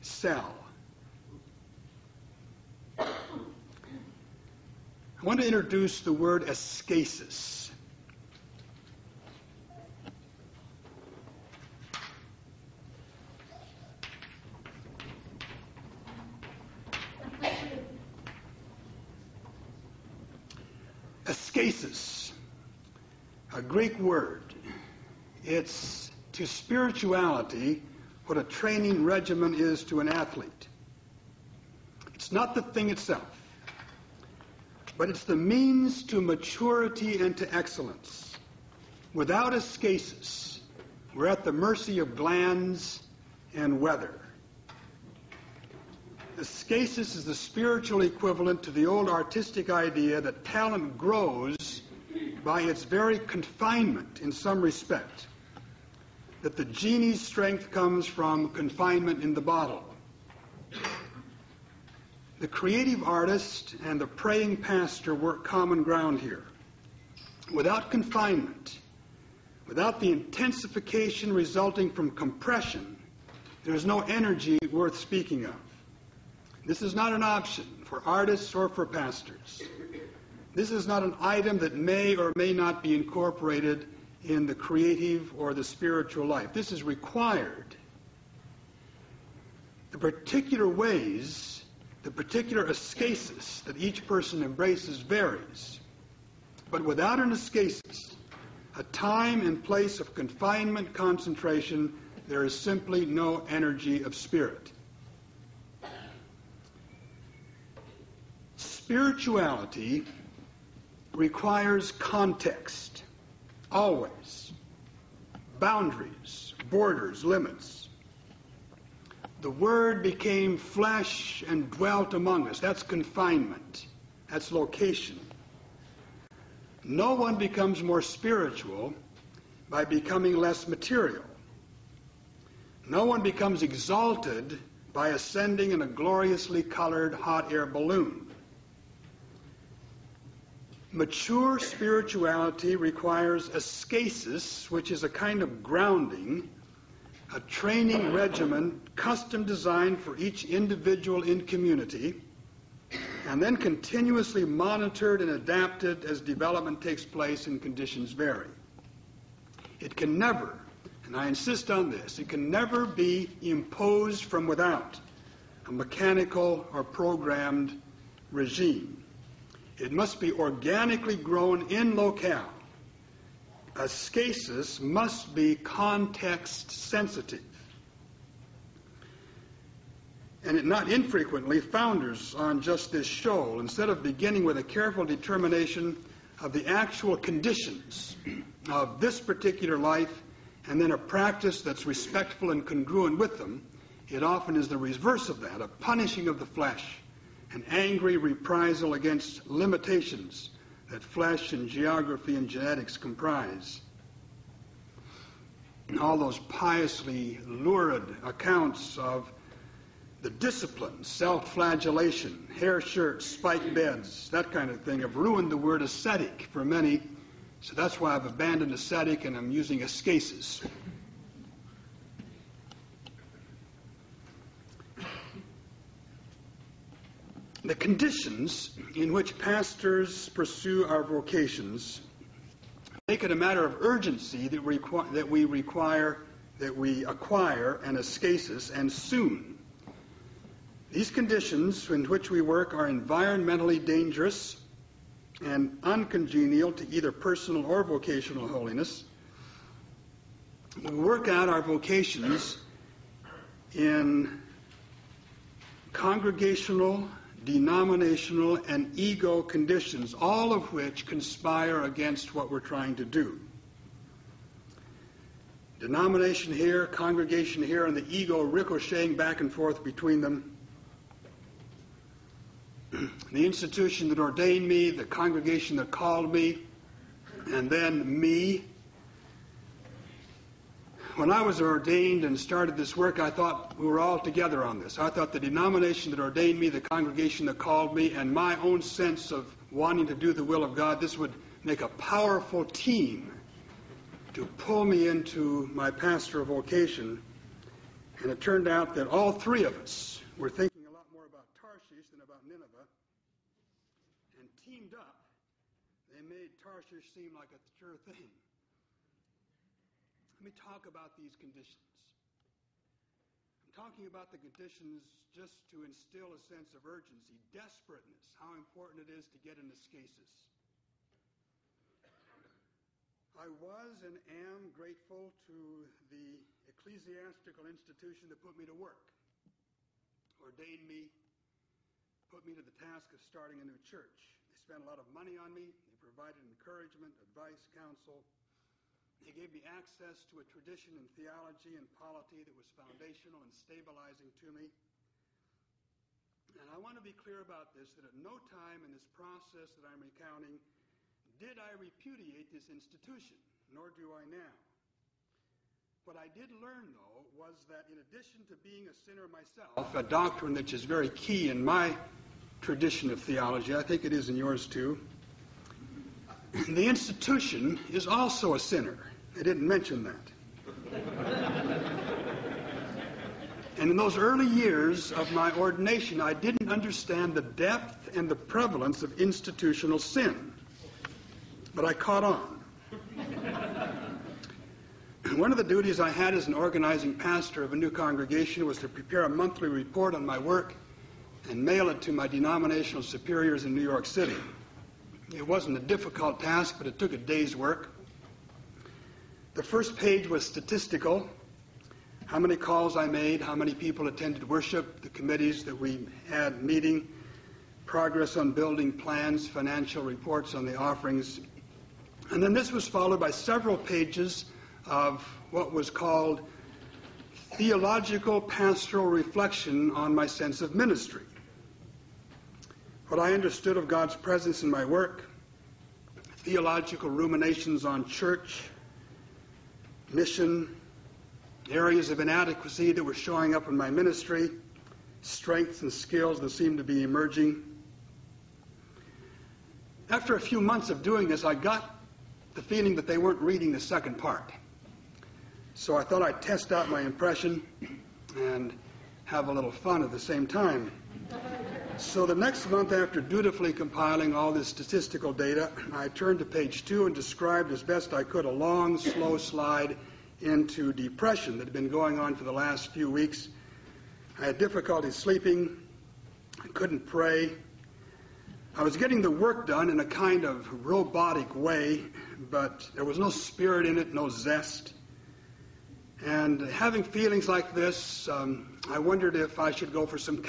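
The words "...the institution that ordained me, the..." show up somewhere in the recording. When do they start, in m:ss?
4:33.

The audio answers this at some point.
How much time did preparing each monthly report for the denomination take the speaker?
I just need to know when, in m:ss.
6:37.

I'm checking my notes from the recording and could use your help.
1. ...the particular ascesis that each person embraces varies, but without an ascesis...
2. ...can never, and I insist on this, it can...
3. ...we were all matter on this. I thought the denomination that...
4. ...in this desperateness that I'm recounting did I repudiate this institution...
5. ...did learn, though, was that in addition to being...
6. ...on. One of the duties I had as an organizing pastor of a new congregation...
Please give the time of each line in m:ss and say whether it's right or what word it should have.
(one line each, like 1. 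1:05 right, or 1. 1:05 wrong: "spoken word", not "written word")
1. 1:32 right
2. 2:39 right
3. 4:43 wrong: "together", not "matter"
4. 5:48 wrong: "process", not "desperateness"
5. 5:56 right
6. 6:22 right.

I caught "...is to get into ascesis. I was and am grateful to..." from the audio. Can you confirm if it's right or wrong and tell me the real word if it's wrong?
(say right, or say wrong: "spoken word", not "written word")
right.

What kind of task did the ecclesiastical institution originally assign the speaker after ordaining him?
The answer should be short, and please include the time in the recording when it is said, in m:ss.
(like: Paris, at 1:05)
starting a new church, at 5:33.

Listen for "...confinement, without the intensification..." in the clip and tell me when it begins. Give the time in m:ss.
1:07.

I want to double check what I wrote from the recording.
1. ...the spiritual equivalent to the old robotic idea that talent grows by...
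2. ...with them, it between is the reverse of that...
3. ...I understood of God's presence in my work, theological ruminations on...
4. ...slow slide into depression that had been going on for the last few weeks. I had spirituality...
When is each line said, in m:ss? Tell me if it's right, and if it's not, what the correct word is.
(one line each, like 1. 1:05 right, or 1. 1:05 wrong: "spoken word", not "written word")
1. 0:47 wrong: "artistic", not "robotic"
2. 3:13 wrong: "often", not "between"
3. 7:03 right
4. 7:38 wrong: "difficulty", not "spirituality".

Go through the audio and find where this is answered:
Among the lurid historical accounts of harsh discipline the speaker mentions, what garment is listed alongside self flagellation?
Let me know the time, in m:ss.
3:32.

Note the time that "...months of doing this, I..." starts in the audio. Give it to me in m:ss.
7:20.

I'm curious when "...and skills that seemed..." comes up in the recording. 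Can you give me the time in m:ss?
7:15.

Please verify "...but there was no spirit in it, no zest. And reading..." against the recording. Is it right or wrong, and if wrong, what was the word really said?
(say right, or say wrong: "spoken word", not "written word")
wrong: "having", not "reading".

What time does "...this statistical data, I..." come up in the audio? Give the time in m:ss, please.
7:34.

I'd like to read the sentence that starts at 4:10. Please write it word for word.
We work out our vocations in congregational denominational, and ego conditions, all of which conspire against what we're trying to do.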